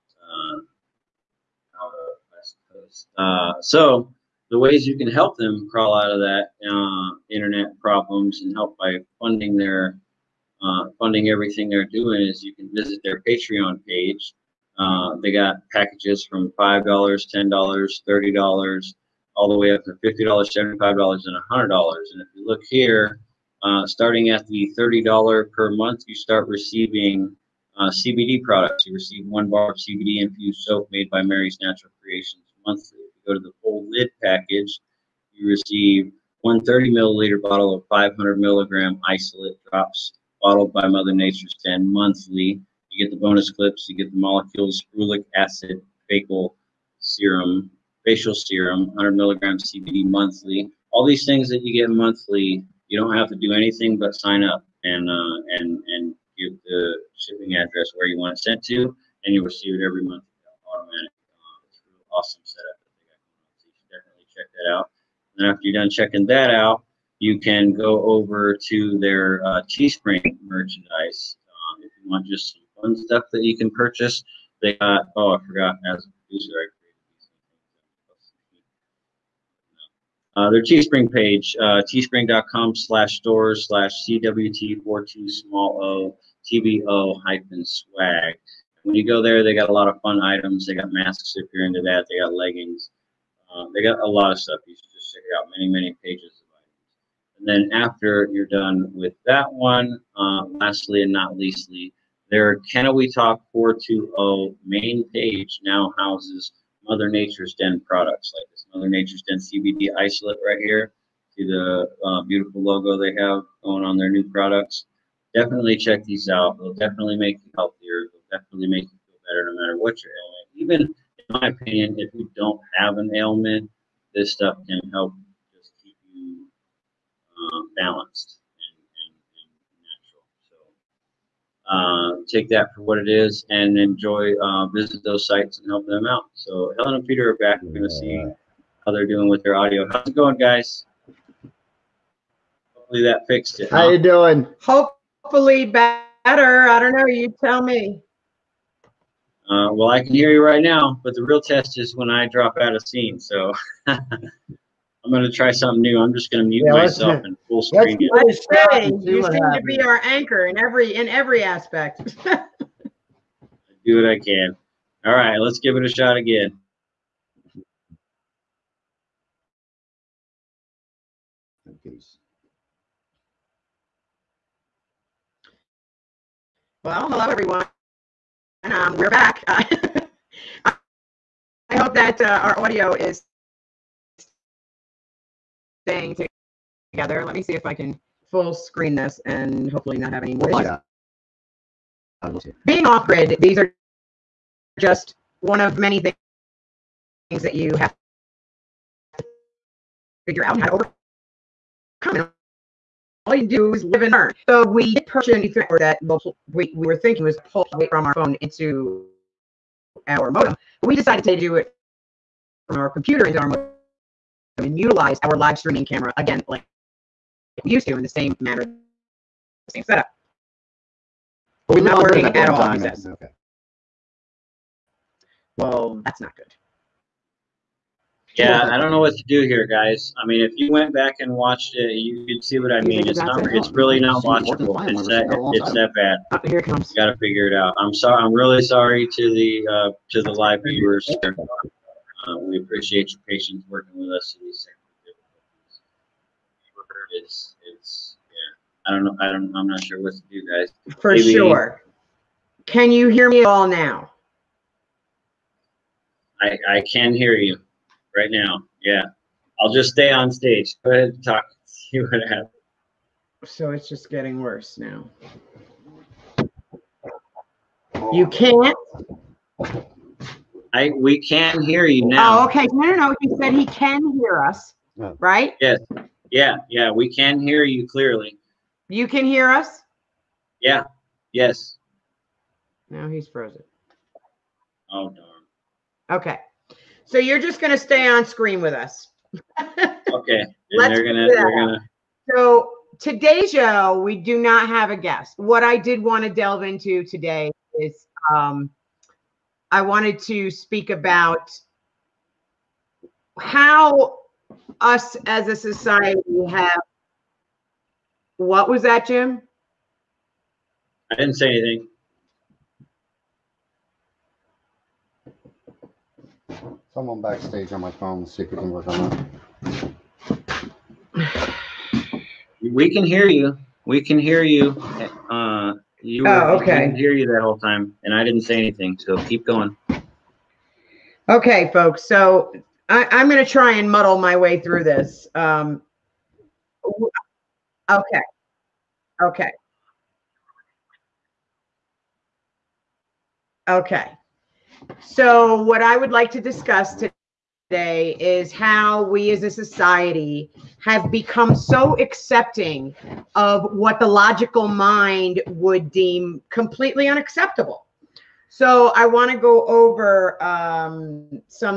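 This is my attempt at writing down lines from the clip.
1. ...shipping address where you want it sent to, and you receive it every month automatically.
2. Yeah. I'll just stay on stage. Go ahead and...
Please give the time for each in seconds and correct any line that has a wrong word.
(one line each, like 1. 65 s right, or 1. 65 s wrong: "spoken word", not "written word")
1. 57 s right
2. 258 s right.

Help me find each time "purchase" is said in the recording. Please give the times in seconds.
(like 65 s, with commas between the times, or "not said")
73 s, 205 s.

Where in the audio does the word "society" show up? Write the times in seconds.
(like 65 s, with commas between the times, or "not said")
305 s, 349 s.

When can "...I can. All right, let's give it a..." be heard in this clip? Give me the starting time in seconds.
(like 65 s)
164 s.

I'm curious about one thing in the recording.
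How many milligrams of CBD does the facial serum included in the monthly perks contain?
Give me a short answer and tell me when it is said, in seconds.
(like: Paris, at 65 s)
100, at 48 s.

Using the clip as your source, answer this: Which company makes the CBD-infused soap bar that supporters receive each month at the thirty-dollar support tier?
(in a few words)
Mary's Natural Creations.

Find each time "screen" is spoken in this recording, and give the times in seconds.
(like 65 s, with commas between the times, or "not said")
157 s, 188 s, 288 s.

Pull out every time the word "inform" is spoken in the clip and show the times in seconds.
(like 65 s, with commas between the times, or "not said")
not said.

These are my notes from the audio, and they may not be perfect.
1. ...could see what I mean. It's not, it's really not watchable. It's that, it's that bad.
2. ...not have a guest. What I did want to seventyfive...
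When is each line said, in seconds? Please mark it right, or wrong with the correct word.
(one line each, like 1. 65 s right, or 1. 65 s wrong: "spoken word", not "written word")
1. 232 s right
2. 294 s wrong: "delve", not "seventyfive".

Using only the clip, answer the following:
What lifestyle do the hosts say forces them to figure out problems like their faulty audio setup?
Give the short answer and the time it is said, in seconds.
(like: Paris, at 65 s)
Being off grid, at 192 s.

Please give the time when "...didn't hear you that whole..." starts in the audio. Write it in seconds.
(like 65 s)
326 s.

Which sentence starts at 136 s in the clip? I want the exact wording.
So Helen and Peter are back.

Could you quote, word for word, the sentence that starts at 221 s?
But we're not working at all, he says.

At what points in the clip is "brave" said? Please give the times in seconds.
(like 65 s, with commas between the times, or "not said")
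not said.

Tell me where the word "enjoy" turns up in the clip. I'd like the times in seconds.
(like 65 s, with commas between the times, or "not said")
133 s.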